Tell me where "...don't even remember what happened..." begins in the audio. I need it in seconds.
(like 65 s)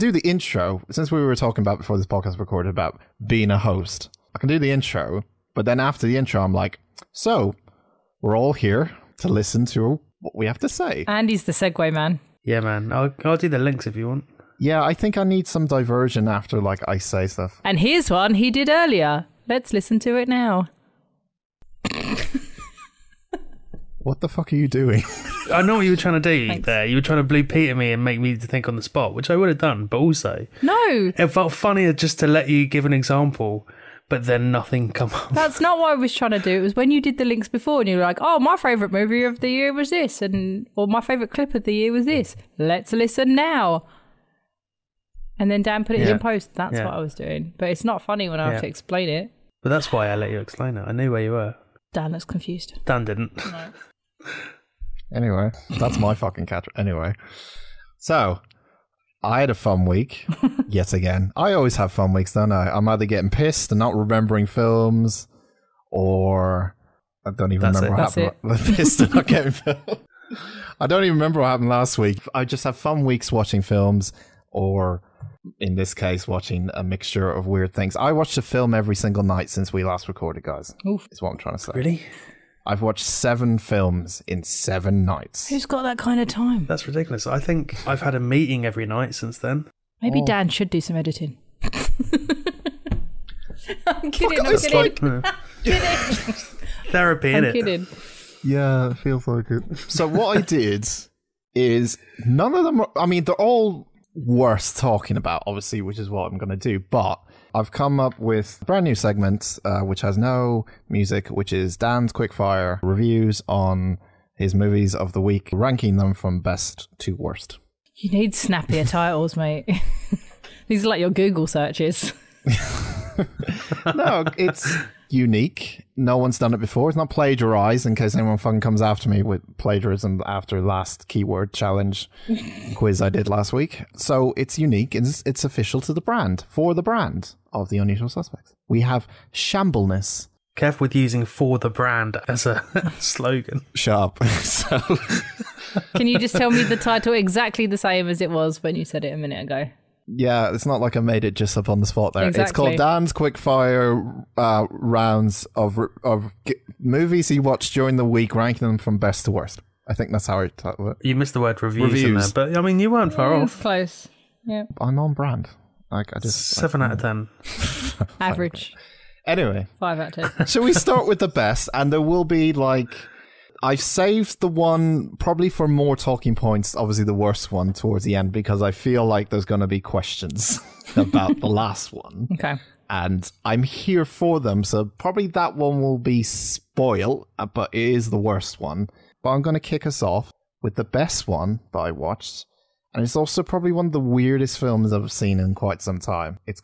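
70 s.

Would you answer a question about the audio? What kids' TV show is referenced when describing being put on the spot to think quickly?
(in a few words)
Blue Peter.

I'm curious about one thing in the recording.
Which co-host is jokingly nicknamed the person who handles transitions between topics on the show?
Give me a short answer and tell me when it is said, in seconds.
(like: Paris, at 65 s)
Andy, at 11 s.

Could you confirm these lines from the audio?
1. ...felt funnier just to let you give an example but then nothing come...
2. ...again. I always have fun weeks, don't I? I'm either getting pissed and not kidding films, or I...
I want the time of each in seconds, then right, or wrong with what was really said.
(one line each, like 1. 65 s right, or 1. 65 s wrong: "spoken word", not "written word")
1. 31 s right
2. 60 s wrong: "remembering", not "kidding".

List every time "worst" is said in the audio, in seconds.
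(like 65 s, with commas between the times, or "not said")
117 s, 159 s, 177 s, 188 s.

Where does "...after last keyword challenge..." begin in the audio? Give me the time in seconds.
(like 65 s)
130 s.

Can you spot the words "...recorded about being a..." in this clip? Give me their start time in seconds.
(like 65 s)
2 s.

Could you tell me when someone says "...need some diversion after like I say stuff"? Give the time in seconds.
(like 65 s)
15 s.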